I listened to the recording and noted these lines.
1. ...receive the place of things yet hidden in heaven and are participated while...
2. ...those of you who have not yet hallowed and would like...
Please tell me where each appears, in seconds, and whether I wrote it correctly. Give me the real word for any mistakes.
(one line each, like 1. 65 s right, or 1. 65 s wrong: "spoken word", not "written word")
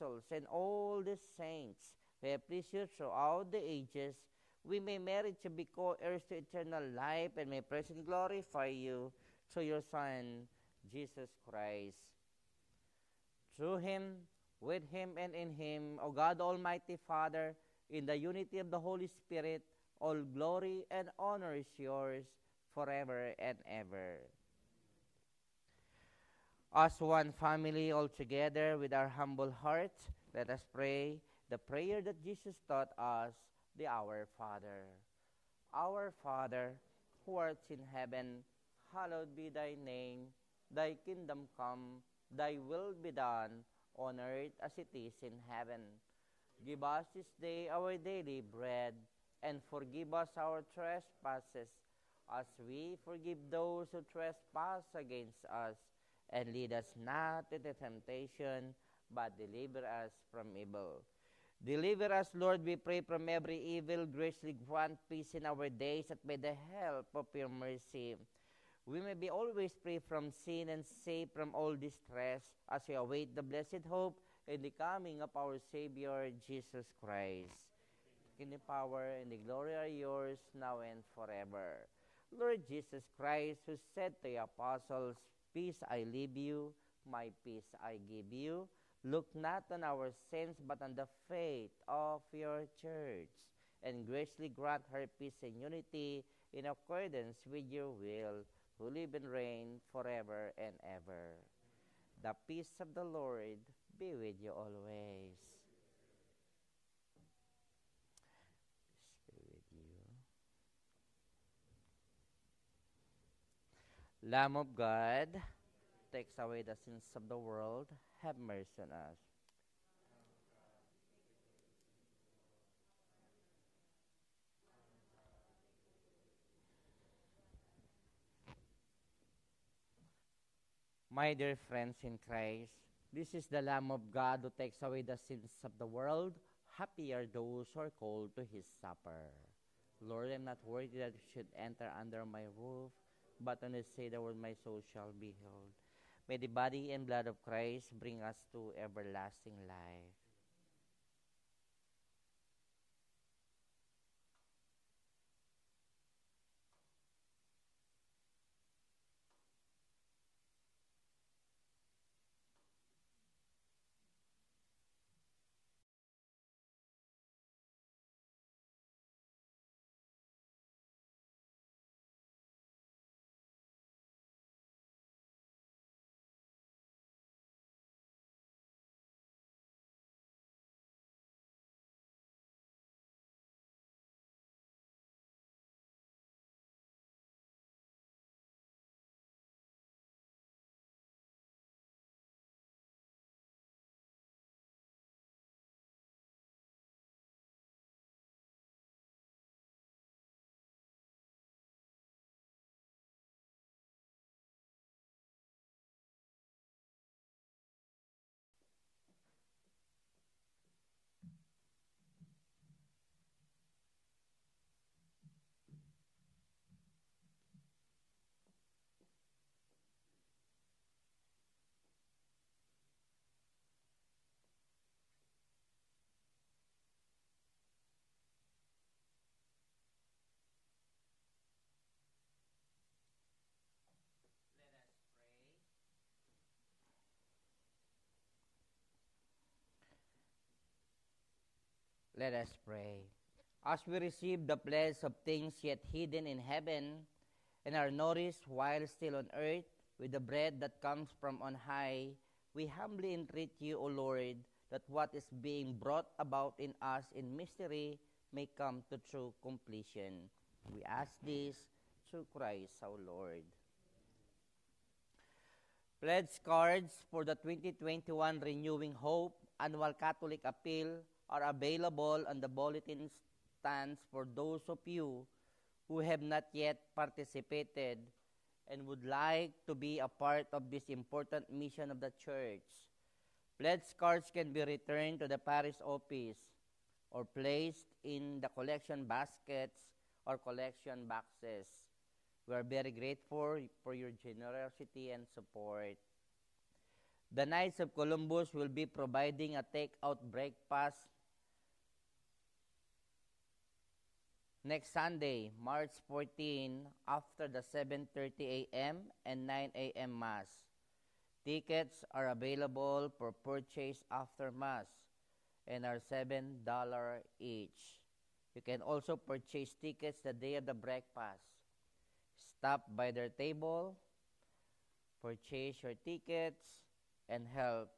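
1. 243 s wrong: "nourished", not "participated"
2. 274 s wrong: "participated", not "hallowed".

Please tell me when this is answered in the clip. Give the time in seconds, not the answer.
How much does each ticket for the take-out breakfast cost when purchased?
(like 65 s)
316 s.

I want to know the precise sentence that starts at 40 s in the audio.
Thy kingdom come, thy will be done, on earth as it is in heaven.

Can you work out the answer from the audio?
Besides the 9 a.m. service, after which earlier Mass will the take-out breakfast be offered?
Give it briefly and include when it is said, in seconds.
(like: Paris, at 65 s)
7:30 a.m., at 307 s.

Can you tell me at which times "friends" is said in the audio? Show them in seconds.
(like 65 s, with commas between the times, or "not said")
131 s.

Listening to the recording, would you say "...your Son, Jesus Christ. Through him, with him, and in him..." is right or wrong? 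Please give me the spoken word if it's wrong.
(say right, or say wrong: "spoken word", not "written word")
right.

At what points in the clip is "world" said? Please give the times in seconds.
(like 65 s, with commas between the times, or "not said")
117 s, 135 s.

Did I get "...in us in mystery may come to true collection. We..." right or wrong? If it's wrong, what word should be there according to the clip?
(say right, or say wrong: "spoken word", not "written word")
wrong: "completion", not "collection".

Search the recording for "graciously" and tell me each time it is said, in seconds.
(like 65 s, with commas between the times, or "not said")
64 s, 94 s.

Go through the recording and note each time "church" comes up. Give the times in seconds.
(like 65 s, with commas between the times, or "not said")
92 s, 282 s.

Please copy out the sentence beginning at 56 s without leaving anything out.
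And lead us not into temptation, but deliver us from evil.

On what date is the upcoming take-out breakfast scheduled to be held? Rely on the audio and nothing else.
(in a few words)
March 14.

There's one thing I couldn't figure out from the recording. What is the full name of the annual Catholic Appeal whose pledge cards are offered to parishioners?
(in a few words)
2021 Renewing Hope.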